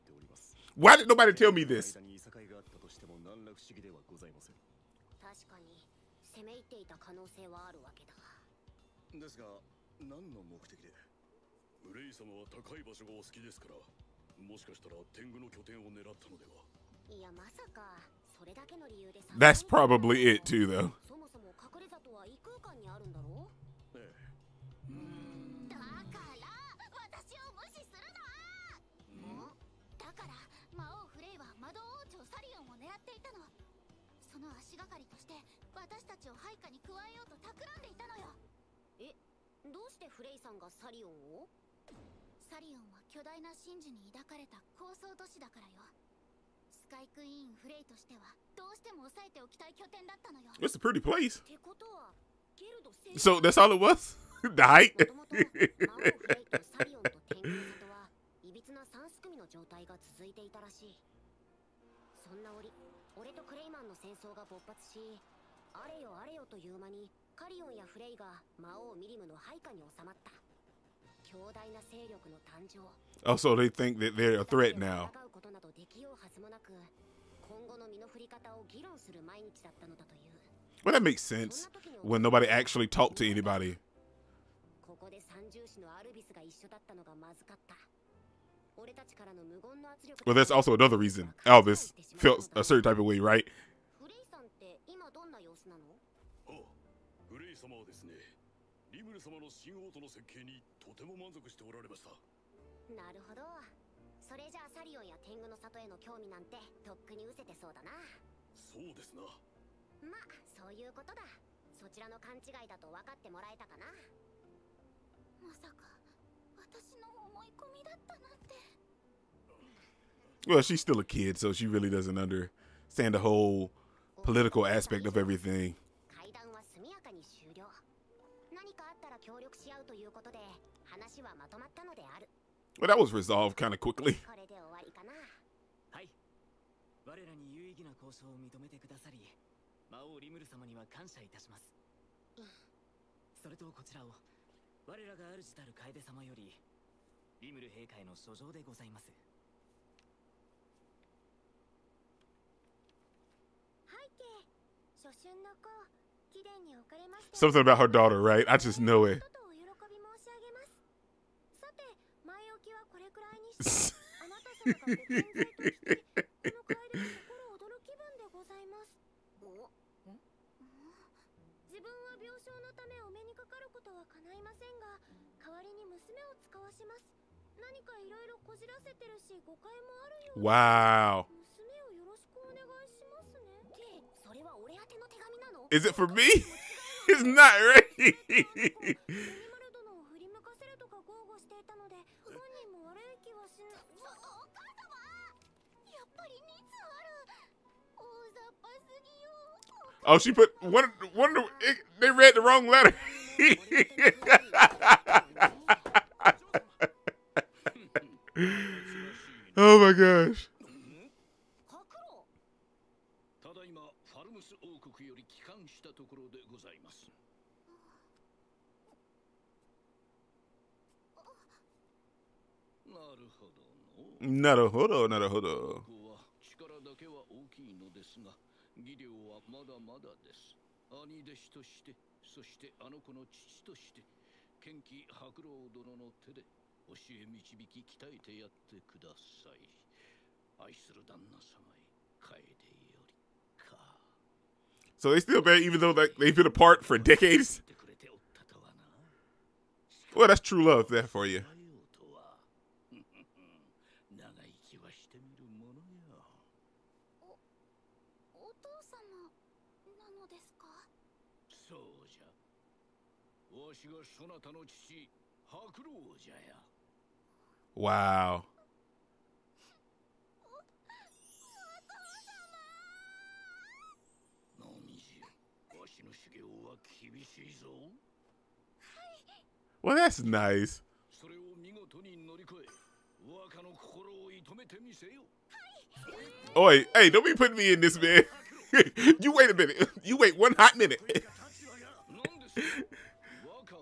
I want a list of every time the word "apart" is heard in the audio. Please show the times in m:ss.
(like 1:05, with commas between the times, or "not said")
4:06.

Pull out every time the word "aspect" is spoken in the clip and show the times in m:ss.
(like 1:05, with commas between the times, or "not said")
2:04.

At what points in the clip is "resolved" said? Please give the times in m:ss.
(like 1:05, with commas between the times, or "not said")
2:13.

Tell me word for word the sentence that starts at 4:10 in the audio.
Well, that's true love there for you.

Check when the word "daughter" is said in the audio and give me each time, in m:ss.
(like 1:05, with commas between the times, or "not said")
2:37.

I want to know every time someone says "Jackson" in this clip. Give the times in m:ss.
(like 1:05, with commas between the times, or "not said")
not said.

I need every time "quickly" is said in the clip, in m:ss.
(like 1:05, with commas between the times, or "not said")
2:13.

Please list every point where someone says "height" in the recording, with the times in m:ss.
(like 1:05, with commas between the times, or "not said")
0:54.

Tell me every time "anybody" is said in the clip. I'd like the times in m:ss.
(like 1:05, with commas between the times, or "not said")
1:23.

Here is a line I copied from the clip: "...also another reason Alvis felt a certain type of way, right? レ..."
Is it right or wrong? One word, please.
right.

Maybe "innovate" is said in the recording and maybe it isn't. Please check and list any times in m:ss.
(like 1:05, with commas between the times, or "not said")
not said.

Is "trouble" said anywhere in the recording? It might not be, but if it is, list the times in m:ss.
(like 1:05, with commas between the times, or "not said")
not said.